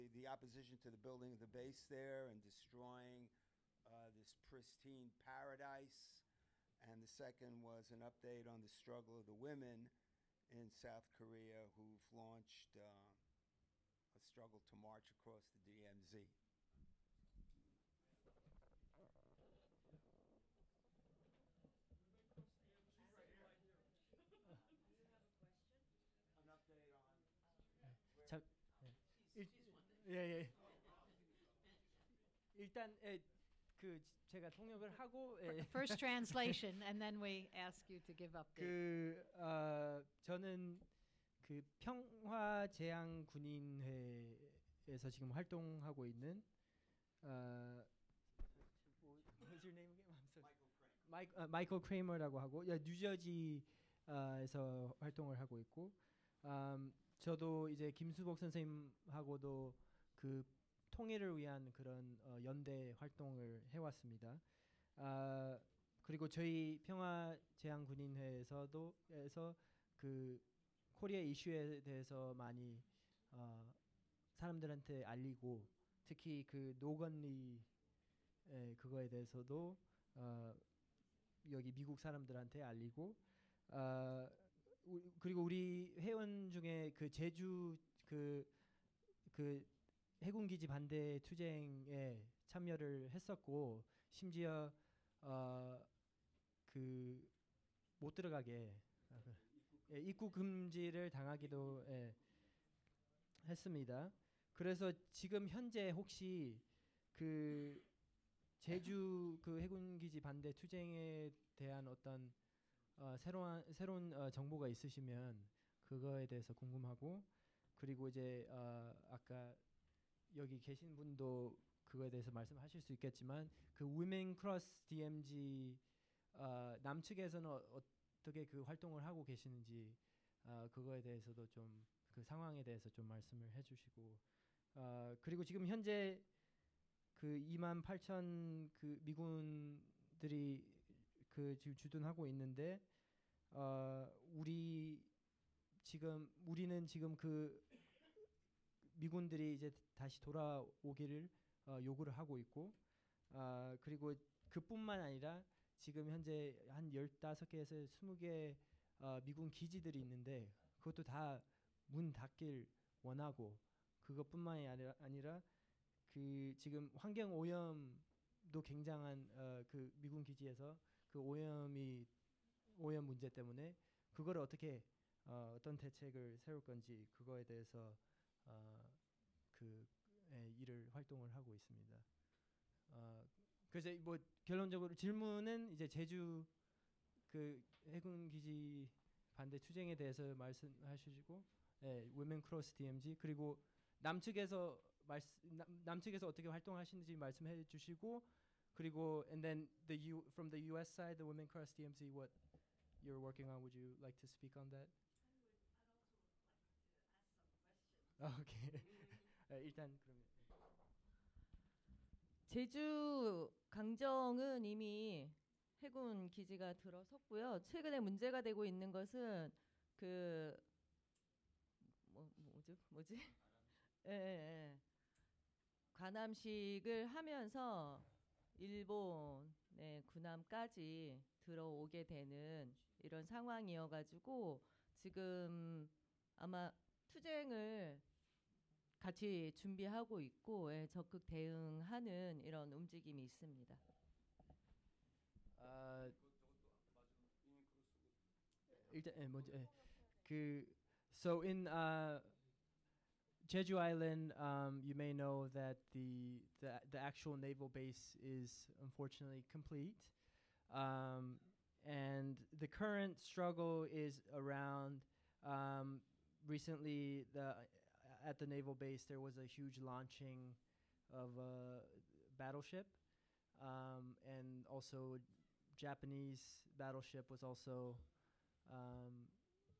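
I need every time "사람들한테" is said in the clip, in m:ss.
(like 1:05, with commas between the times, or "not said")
1:14, 1:21.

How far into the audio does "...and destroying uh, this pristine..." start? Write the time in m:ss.
0:02.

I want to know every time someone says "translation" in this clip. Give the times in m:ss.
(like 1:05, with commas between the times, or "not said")
0:35.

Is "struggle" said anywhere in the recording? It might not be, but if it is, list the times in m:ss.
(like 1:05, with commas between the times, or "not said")
0:08, 0:14, 4:23.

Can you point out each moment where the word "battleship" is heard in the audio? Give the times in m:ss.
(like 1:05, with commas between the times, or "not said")
4:32, 4:36.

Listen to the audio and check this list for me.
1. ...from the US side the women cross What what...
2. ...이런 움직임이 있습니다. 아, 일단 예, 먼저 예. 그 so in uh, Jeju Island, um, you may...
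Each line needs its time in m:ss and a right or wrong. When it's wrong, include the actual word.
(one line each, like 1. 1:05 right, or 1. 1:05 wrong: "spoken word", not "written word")
1. 3:20 wrong: "DMZ", not "What"
2. 4:02 right.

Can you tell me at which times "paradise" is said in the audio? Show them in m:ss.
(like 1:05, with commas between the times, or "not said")
0:05.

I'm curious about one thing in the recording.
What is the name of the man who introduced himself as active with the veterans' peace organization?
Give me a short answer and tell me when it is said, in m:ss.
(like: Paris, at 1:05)
Michael Kramer, at 0:51.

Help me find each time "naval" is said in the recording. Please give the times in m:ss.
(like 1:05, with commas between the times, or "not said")
4:17, 4:28.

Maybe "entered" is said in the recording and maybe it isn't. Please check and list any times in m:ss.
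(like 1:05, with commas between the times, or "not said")
not said.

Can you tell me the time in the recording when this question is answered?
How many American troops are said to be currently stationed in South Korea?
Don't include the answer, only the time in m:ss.
2:17.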